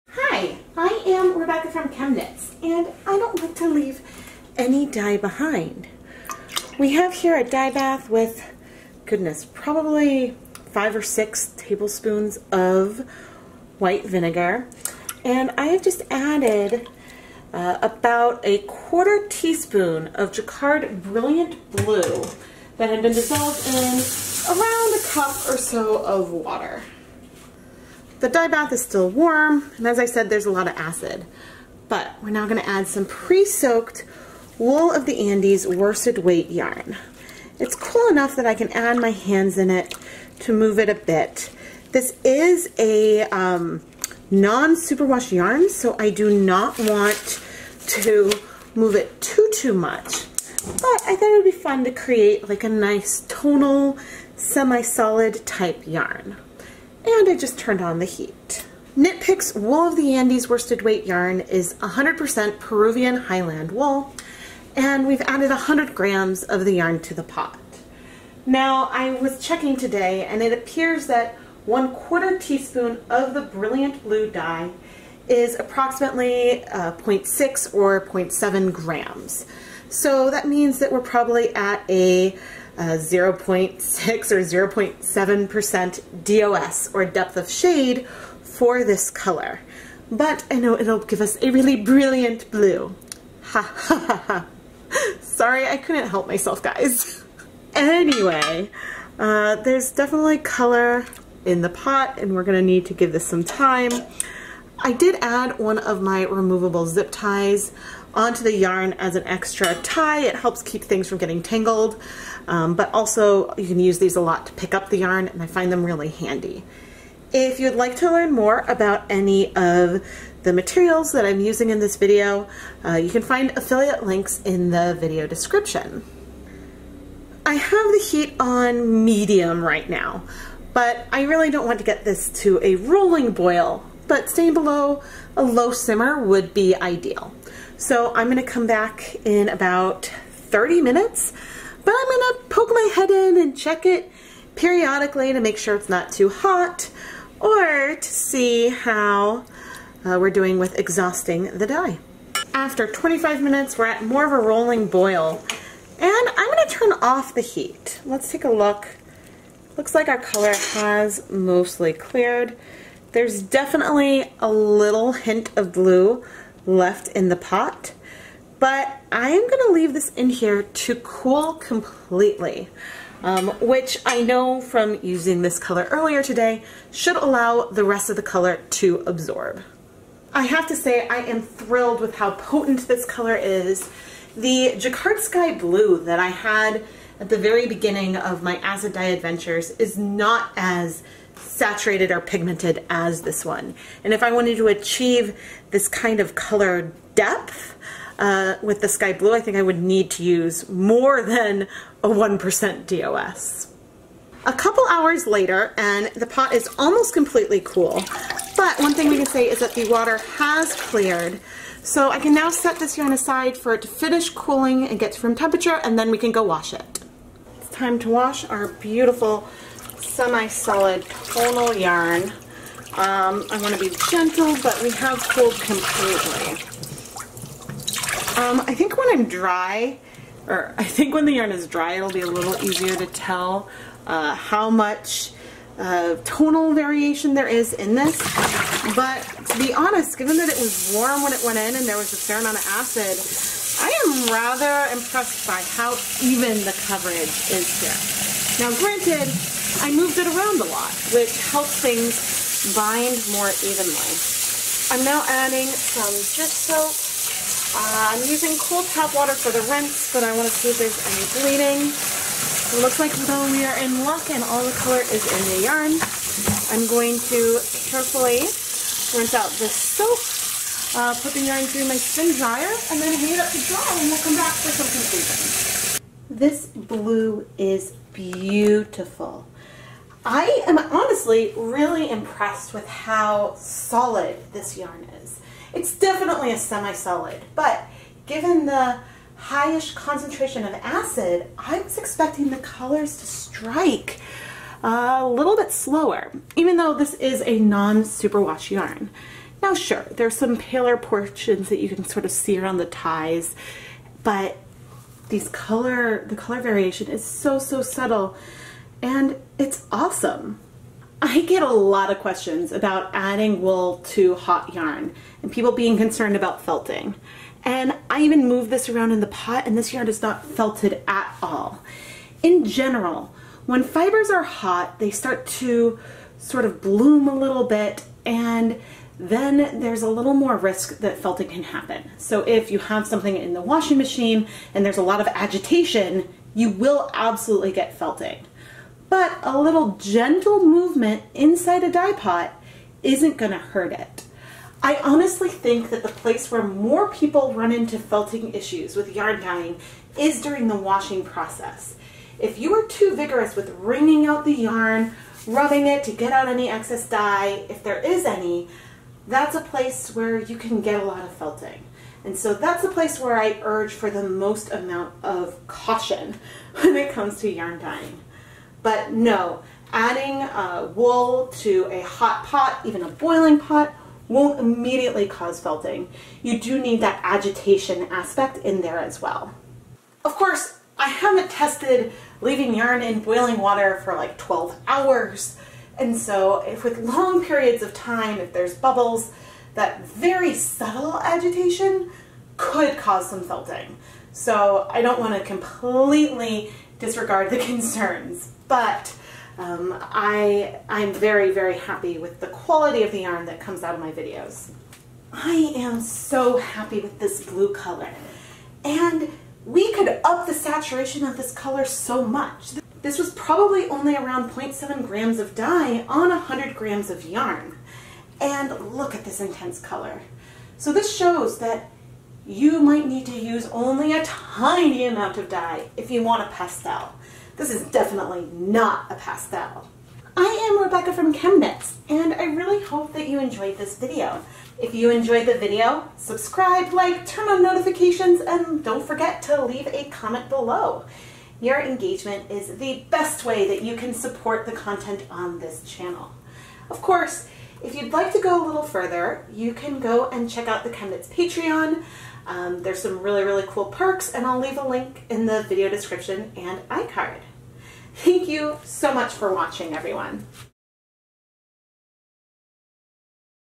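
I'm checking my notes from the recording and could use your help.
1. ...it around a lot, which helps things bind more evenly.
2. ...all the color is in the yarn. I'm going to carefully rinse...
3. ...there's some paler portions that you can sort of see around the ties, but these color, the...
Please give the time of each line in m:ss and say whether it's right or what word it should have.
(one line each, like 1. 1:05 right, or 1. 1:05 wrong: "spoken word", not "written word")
1. 4:10 right
2. 4:24 right
3. 5:00 right.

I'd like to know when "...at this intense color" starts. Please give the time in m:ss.
6:59.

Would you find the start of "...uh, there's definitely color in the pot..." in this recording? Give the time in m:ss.
1:39.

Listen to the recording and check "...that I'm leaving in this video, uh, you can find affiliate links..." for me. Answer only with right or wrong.
wrong.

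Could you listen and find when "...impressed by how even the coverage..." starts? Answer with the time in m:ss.
4:04.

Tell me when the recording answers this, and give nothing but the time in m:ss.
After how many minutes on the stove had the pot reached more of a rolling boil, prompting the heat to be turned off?
2:32.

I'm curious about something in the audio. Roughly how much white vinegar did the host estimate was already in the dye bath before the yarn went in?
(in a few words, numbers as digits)
5 or 6 tablespoons.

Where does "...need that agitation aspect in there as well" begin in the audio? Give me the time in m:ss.
6:16.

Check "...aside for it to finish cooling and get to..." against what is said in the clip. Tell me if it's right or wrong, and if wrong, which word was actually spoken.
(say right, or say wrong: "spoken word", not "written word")
right.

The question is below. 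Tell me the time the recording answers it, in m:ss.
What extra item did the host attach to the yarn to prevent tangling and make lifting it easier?
1:46.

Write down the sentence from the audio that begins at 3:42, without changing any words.
Um, I want to be gentle, but we have cooled completely.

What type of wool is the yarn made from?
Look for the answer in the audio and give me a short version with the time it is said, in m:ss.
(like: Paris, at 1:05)
Peruvian Highland wool, at 1:02.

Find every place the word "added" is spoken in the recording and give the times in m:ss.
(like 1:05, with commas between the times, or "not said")
0:16, 1:05.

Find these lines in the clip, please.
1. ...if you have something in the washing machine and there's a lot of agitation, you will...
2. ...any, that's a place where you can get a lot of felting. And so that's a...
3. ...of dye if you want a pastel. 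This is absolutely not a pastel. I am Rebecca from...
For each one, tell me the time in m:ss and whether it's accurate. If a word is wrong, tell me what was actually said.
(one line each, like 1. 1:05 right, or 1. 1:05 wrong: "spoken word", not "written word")
1. 5:32 right
2. 5:58 right
3. 7:05 wrong: "definitely", not "absolutely".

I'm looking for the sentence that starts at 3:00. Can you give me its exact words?
I have to say I am thrilled with how potent this color is.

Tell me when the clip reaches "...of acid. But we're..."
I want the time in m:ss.
0:30.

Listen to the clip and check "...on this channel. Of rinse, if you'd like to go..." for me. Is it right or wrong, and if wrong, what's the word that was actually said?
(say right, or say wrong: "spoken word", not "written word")
wrong: "course", not "rinse".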